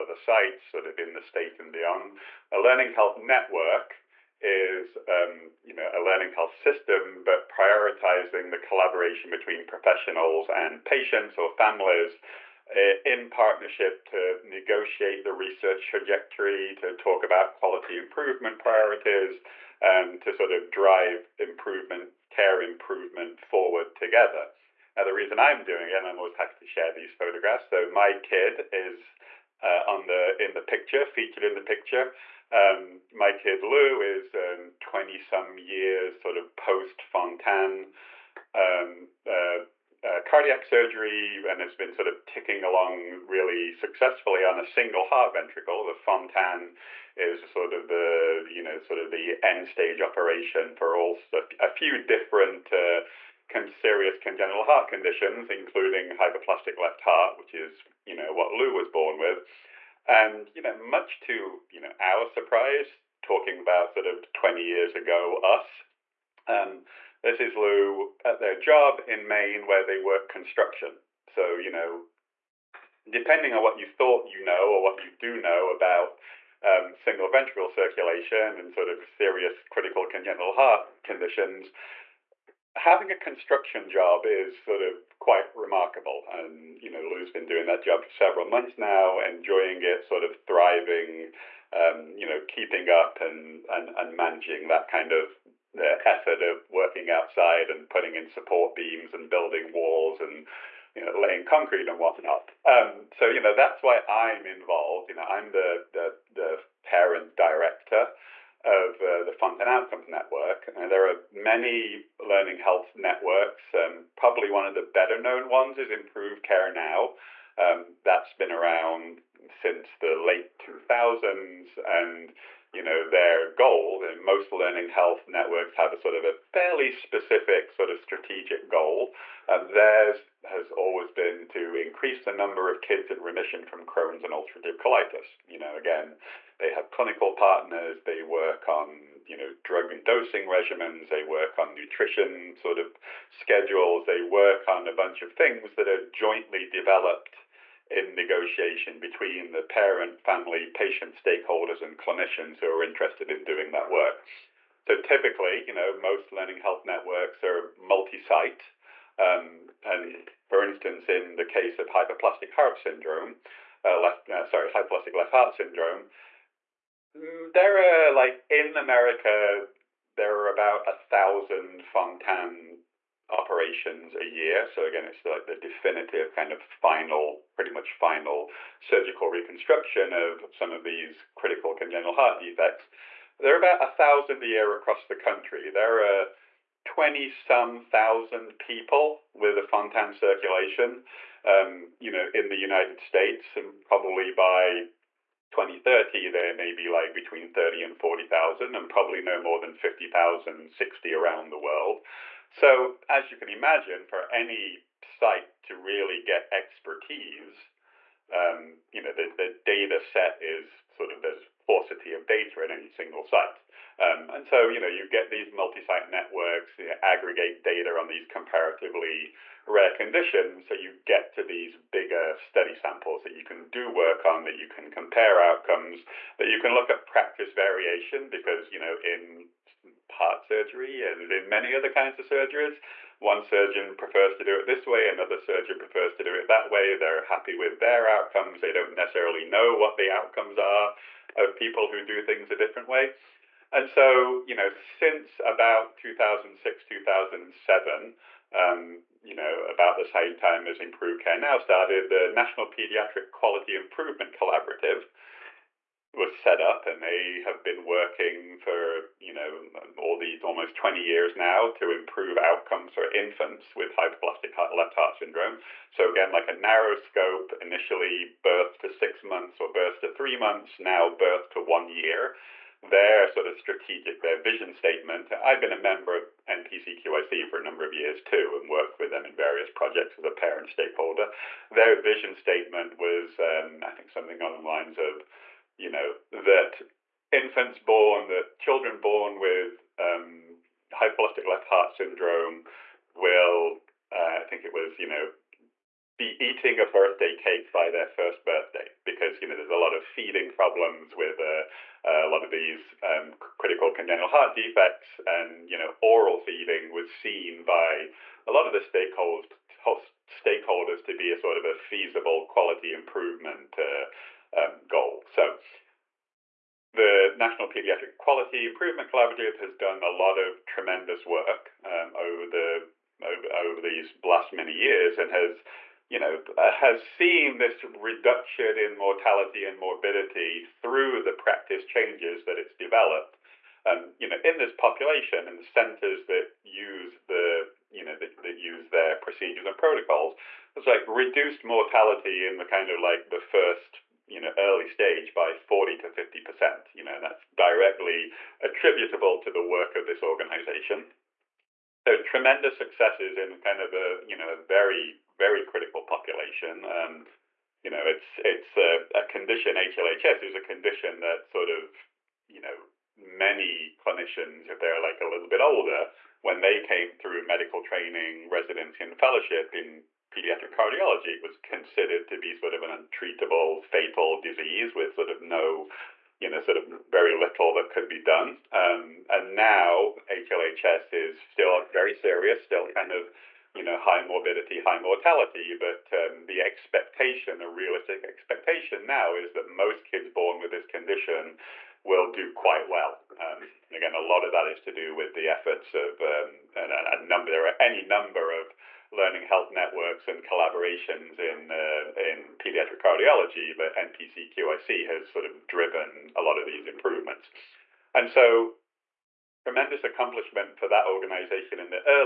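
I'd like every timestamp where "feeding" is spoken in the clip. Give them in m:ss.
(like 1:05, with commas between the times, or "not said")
5:00, 5:06.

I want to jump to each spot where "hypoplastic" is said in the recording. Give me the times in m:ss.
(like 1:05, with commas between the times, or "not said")
2:44, 4:23, 4:50.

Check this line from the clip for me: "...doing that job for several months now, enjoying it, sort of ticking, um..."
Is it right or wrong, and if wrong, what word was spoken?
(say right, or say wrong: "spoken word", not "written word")
wrong: "thriving", not "ticking".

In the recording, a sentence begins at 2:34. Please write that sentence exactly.
So typically, you know, most learning health networks are multi-site.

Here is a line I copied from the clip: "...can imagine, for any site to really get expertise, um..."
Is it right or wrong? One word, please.
right.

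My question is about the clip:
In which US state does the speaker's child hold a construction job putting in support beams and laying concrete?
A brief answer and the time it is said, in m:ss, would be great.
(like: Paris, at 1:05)
Maine, at 1:09.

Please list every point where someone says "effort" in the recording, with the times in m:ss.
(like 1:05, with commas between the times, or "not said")
1:36, 6:35.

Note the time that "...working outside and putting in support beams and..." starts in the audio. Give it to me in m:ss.
1:36.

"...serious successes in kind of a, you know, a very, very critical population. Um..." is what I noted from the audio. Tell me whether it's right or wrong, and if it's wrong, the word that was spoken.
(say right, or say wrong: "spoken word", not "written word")
wrong: "tremendous", not "serious".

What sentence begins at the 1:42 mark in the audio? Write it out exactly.
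Um, so you know that's why I'm involved.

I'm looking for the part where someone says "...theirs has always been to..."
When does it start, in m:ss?
2:09.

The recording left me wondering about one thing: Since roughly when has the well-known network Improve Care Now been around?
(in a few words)
late 2000s.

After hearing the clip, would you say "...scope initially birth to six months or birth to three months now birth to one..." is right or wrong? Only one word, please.
right.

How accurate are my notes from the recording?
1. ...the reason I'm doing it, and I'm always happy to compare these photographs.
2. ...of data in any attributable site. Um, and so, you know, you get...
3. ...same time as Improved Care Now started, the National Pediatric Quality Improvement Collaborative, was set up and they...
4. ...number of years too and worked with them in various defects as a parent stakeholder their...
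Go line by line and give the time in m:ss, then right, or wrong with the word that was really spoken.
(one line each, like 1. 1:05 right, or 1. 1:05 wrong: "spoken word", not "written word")
1. 0:25 wrong: "share", not "compare"
2. 3:32 wrong: "single", not "attributable"
3. 4:10 right
4. 4:37 wrong: "projects", not "defects".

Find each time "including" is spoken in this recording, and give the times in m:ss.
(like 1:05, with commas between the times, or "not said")
0:55.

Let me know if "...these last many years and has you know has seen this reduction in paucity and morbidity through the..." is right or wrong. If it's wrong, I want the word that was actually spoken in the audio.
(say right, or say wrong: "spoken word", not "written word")
wrong: "mortality", not "paucity".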